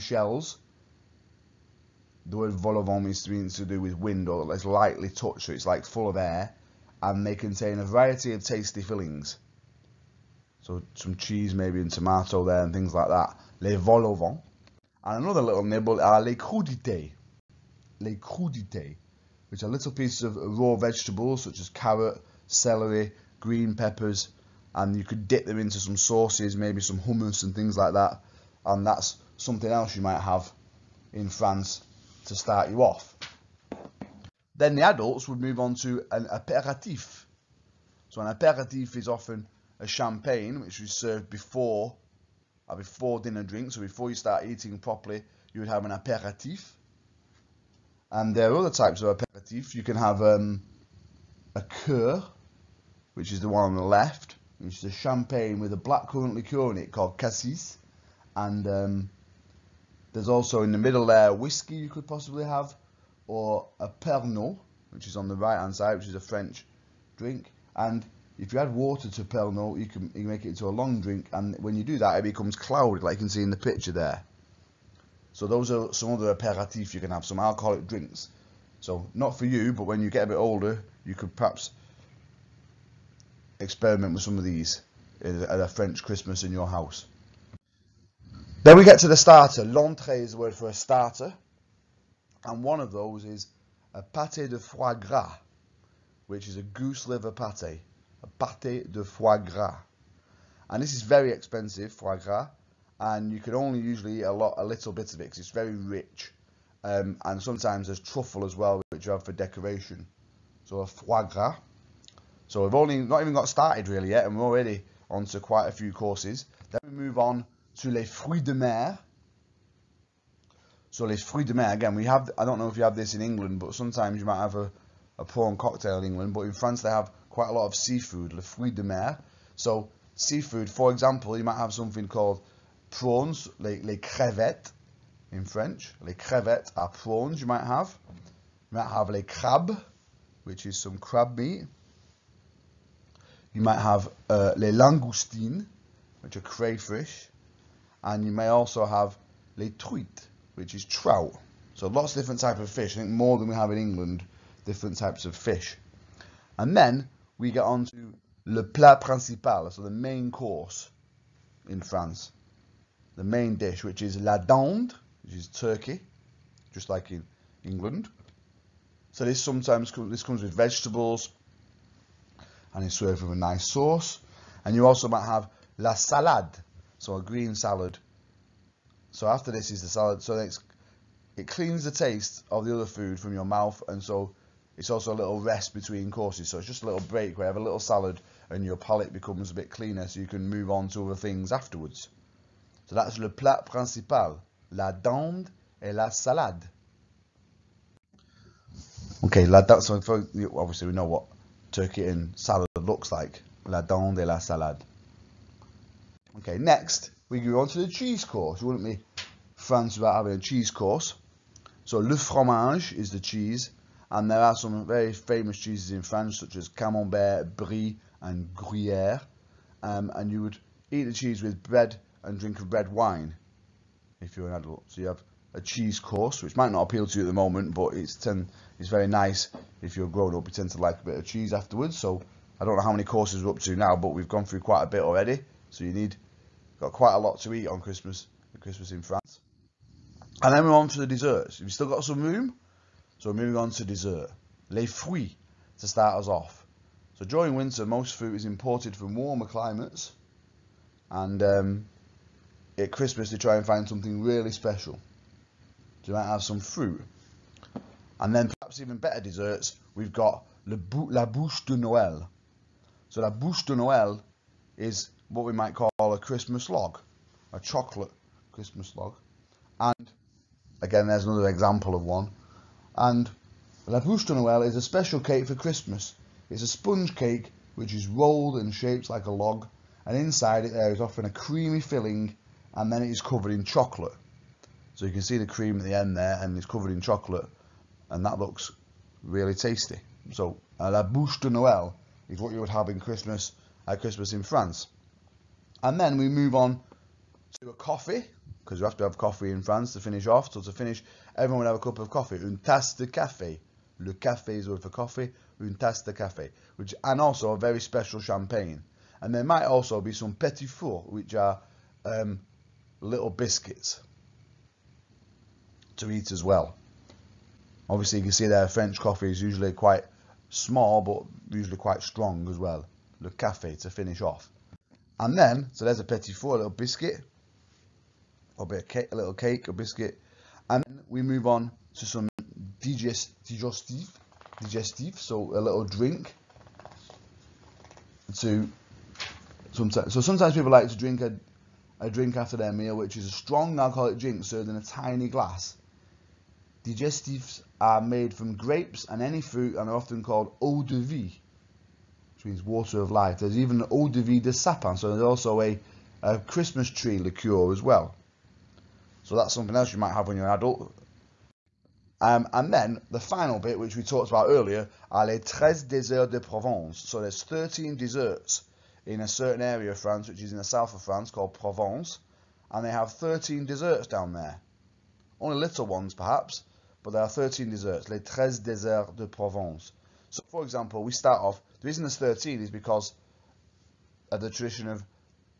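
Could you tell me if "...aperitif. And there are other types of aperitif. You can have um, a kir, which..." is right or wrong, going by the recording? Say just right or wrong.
right.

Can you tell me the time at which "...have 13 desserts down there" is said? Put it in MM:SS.
06:12.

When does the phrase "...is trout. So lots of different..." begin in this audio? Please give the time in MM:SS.
02:30.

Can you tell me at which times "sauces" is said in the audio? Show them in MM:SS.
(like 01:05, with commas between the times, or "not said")
00:25, 02:53.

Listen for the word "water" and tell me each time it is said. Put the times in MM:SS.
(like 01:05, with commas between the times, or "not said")
01:08, 05:52.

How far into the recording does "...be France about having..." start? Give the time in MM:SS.
03:28.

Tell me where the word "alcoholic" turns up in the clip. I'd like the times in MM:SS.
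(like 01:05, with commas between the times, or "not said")
01:17, 05:43.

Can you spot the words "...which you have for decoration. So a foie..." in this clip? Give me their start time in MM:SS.
01:48.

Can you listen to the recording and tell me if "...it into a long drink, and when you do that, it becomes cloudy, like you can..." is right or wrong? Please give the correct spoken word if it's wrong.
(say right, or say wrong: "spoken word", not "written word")
right.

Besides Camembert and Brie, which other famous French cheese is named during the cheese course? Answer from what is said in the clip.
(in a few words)
Gruyere.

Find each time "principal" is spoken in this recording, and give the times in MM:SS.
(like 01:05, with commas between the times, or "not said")
02:38, 03:13.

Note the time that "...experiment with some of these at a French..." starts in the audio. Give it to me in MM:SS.
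01:23.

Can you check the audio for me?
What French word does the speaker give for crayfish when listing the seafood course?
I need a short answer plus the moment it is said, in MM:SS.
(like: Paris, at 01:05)
les langoustines, at 02:24.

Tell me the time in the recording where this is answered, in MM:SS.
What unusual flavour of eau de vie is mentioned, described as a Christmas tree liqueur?
05:53.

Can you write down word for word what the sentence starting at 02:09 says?
So seafood, for example, you might have something called prawns, les, les crevettes in French.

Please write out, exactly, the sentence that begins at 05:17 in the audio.
Obviously, you can see there French coffee is usually quite small, but usually quite strong as well.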